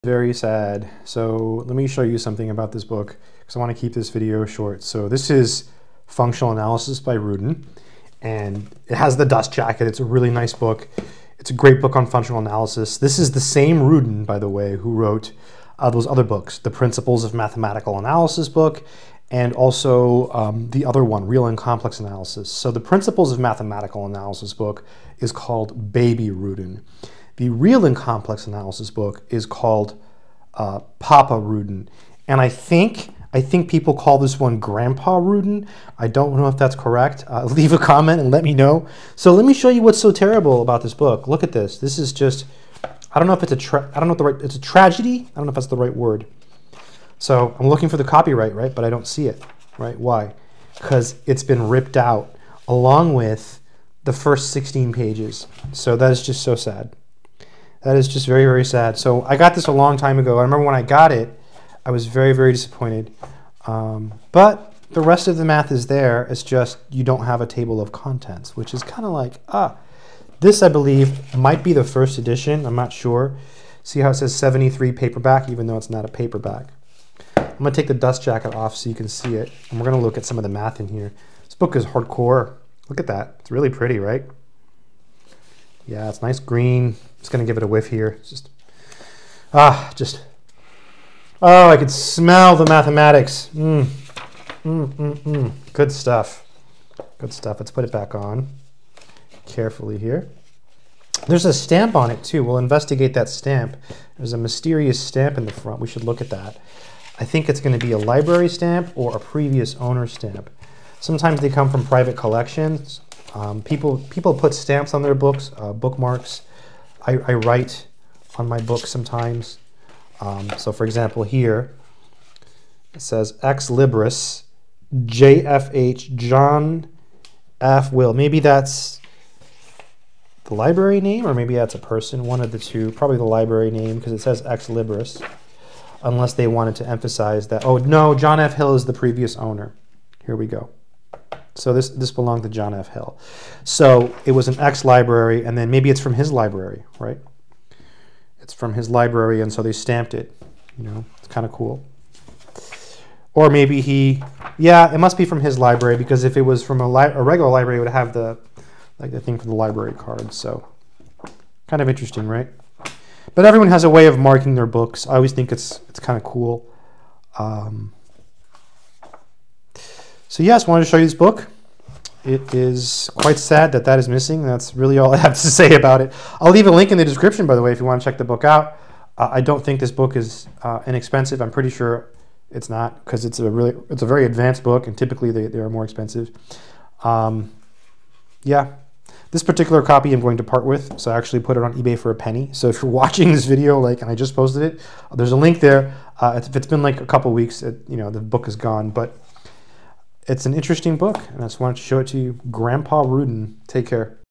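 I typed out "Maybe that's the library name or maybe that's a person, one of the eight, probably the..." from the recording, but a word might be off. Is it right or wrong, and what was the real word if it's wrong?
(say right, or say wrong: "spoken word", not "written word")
wrong: "two", not "eight".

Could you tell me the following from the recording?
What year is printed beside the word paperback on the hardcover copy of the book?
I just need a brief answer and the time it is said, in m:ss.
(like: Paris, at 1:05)
73, at 1:14.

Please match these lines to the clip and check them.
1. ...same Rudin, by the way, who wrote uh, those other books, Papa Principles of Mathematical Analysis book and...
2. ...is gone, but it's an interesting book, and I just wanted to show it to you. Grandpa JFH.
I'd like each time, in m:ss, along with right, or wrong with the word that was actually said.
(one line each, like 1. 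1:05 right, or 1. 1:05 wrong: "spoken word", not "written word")
1. 0:13 wrong: "The", not "Papa"
2. 3:18 wrong: "Rudin", not "JFH".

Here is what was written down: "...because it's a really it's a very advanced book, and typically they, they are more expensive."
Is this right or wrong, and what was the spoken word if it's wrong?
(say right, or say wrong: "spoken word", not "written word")
right.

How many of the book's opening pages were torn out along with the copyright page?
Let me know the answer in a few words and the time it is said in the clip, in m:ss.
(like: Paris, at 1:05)
16, at 0:54.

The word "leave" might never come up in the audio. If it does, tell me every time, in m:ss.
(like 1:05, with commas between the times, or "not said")
0:37, 2:56.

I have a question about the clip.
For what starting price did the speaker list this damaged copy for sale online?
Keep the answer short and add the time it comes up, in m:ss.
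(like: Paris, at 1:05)
A penny, at 3:12.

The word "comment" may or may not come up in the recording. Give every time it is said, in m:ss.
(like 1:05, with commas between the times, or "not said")
0:37.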